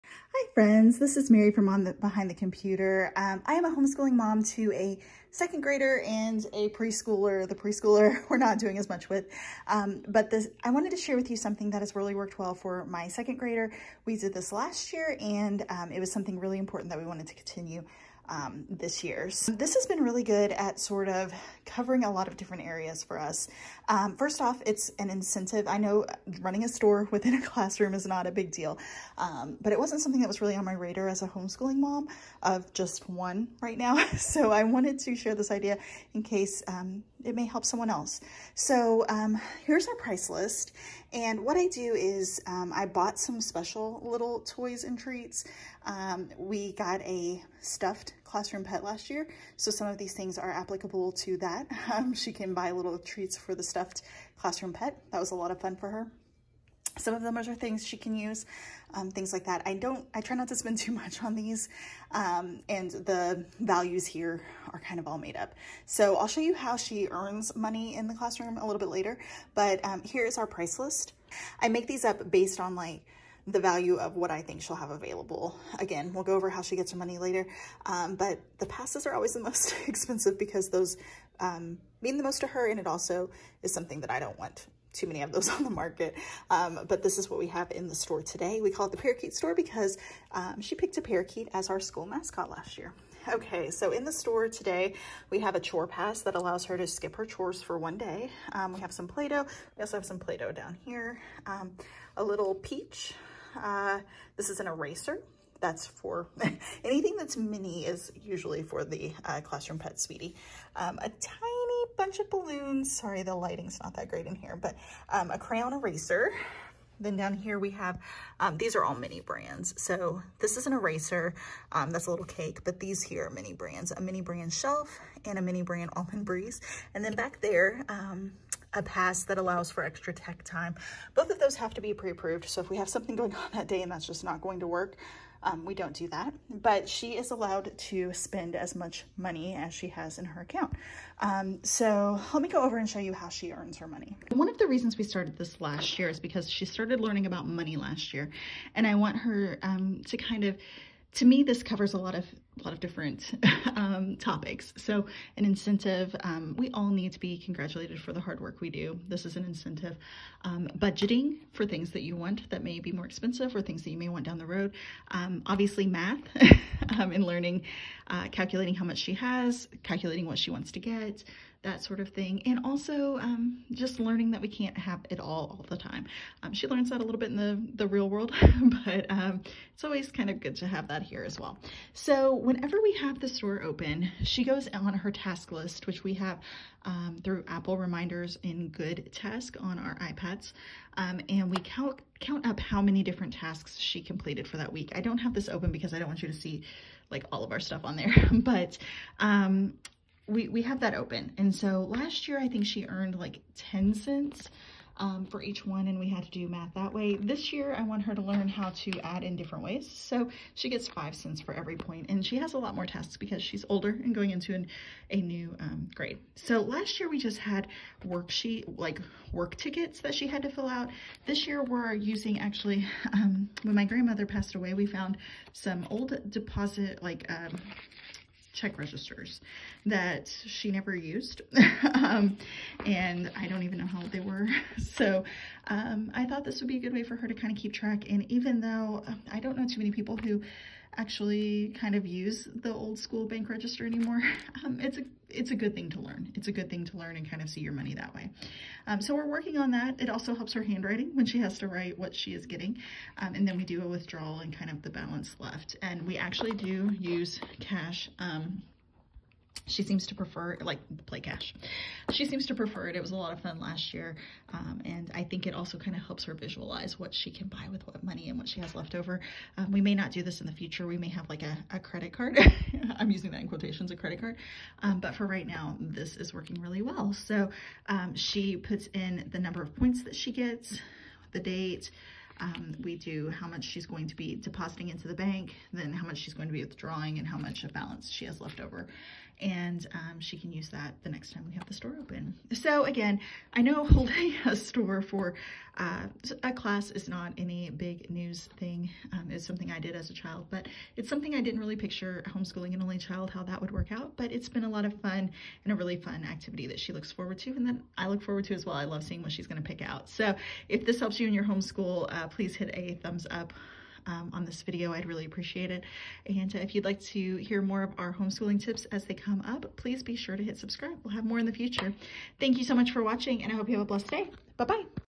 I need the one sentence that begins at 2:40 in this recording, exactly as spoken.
Um, budgeting for things that you want that may be more expensive or things that you may want down the road.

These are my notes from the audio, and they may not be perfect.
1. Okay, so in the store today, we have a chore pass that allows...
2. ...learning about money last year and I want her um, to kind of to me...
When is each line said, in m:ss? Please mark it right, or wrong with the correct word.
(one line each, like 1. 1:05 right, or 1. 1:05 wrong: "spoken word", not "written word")
1. 1:33 right
2. 2:26 right.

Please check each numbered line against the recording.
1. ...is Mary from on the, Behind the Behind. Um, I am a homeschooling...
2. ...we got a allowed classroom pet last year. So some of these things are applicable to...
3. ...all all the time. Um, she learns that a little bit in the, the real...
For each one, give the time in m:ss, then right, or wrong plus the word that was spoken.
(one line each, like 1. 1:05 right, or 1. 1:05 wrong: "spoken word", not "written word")
1. 0:01 wrong: "Computer", not "Behind"
2. 0:46 wrong: "stuffed", not "allowed"
3. 2:55 right.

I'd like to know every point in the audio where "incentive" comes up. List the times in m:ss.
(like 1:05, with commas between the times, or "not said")
0:25, 2:35, 2:39.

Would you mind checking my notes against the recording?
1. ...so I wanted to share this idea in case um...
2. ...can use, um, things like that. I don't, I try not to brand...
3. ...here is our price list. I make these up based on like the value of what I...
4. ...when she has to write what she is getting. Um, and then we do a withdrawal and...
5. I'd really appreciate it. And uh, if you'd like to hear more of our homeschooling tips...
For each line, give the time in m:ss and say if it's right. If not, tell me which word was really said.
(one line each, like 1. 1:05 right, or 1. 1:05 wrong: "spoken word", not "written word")
1. 0:34 right
2. 0:57 wrong: "spend", not "brand"
3. 1:10 right
4. 4:11 right
5. 5:14 right.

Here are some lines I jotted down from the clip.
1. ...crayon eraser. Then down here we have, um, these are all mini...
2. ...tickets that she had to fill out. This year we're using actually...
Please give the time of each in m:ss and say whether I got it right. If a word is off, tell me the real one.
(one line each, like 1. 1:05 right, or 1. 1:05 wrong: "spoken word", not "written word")
1. 1:55 right
2. 3:39 right.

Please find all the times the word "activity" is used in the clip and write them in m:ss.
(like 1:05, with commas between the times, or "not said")
5:06.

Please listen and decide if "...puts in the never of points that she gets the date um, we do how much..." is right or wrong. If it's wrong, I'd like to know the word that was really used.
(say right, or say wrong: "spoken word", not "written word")
wrong: "number", not "never".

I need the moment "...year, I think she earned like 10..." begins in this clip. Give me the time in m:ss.
3:22.